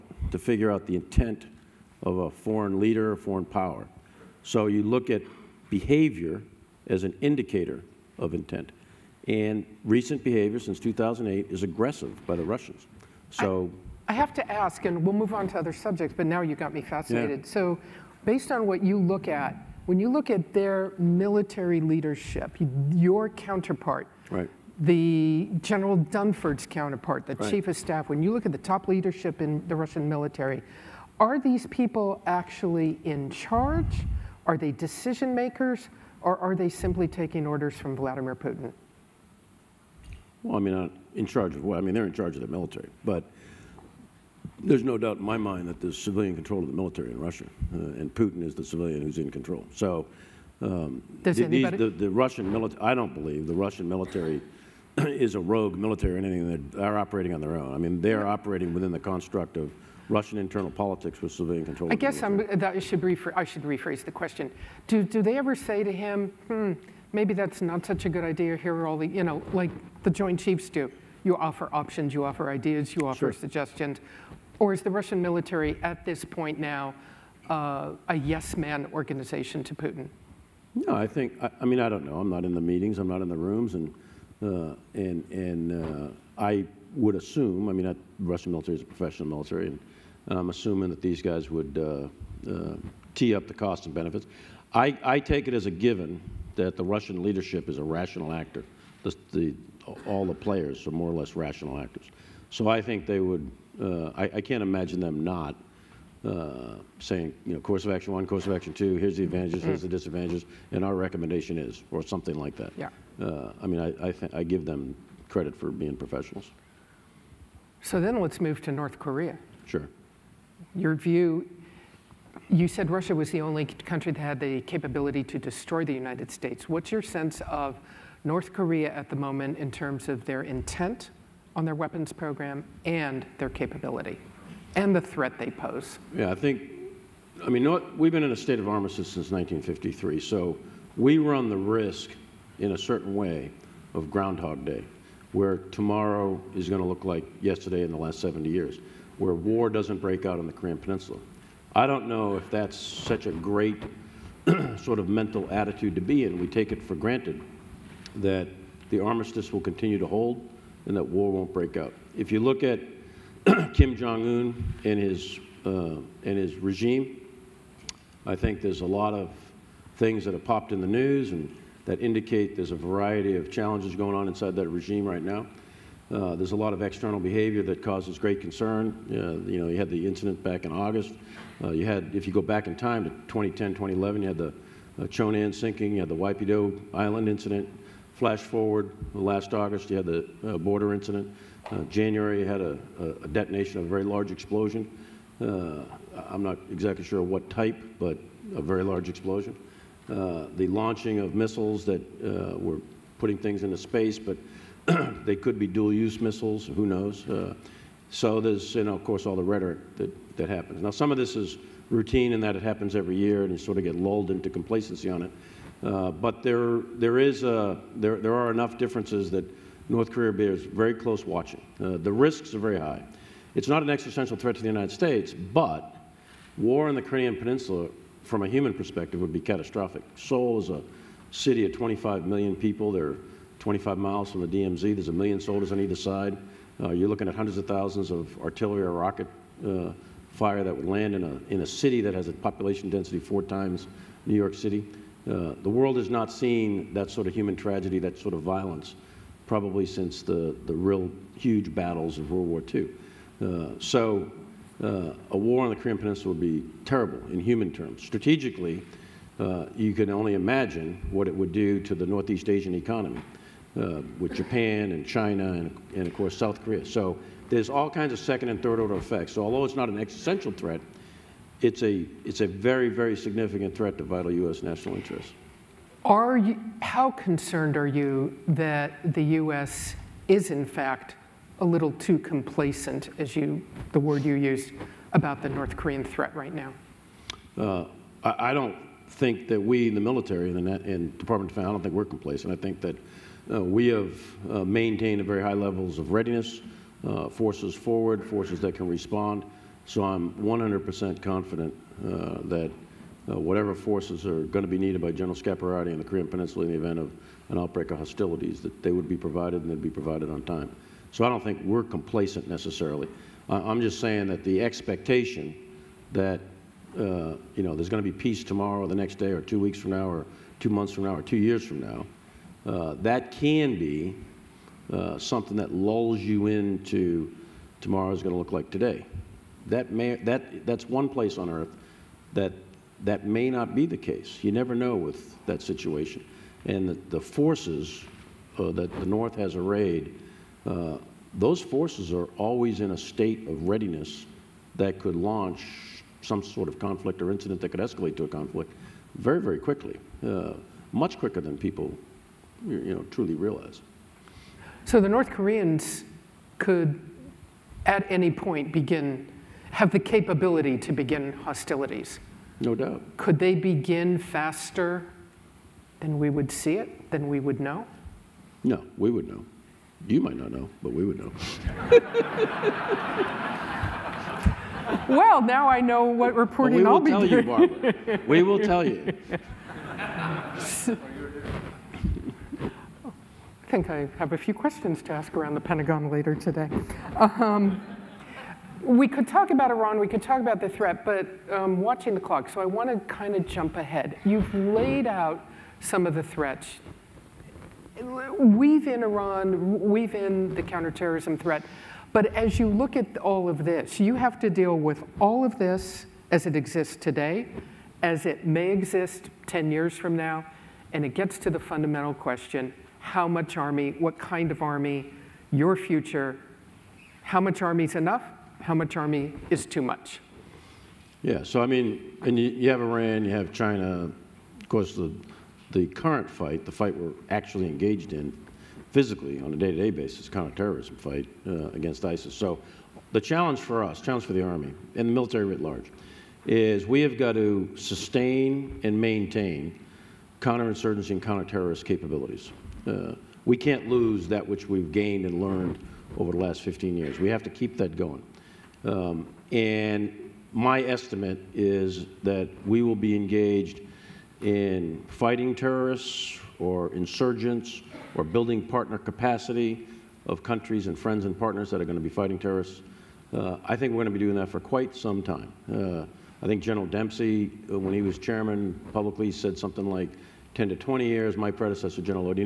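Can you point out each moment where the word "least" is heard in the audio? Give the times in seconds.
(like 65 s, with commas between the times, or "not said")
not said.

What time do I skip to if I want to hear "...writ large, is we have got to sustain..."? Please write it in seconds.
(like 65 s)
435 s.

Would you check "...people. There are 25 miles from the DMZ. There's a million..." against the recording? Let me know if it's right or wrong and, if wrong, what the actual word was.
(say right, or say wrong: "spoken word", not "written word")
right.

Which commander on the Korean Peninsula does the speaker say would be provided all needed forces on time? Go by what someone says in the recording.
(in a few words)
General Scaparrotti.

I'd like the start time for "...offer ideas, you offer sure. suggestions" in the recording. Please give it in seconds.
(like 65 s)
72 s.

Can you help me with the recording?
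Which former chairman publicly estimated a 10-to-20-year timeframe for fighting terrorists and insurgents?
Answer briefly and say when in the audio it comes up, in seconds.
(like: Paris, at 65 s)
General Dempsey, at 466 s.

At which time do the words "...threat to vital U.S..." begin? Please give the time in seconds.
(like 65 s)
273 s.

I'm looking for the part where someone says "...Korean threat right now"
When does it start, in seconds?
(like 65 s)
285 s.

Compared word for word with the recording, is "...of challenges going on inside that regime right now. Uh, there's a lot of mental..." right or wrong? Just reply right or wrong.
wrong.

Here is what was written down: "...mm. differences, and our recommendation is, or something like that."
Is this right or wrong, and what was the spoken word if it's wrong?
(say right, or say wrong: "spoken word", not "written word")
wrong: "disadvantages", not "differences".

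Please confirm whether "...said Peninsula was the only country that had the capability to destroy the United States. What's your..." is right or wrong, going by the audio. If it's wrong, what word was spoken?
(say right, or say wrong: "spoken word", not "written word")
wrong: "Russia", not "Peninsula".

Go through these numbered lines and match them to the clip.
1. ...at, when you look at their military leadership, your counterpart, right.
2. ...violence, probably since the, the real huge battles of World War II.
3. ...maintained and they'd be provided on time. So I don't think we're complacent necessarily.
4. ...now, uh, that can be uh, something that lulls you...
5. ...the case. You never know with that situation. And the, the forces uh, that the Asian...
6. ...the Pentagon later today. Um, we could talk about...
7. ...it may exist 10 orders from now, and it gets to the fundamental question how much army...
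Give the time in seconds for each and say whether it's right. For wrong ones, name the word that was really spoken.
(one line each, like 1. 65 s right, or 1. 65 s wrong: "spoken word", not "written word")
1. 19 s right
2. 248 s right
3. 309 s wrong: "provided", not "maintained"
4. 321 s right
5. 333 s wrong: "North", not "Asian"
6. 385 s right
7. 408 s wrong: "years", not "orders".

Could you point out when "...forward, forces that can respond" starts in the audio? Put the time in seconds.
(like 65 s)
297 s.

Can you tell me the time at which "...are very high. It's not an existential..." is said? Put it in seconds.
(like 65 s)
222 s.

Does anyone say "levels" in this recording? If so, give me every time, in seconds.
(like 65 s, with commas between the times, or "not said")
295 s.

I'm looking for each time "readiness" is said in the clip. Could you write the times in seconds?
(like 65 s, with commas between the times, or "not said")
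296 s, 343 s.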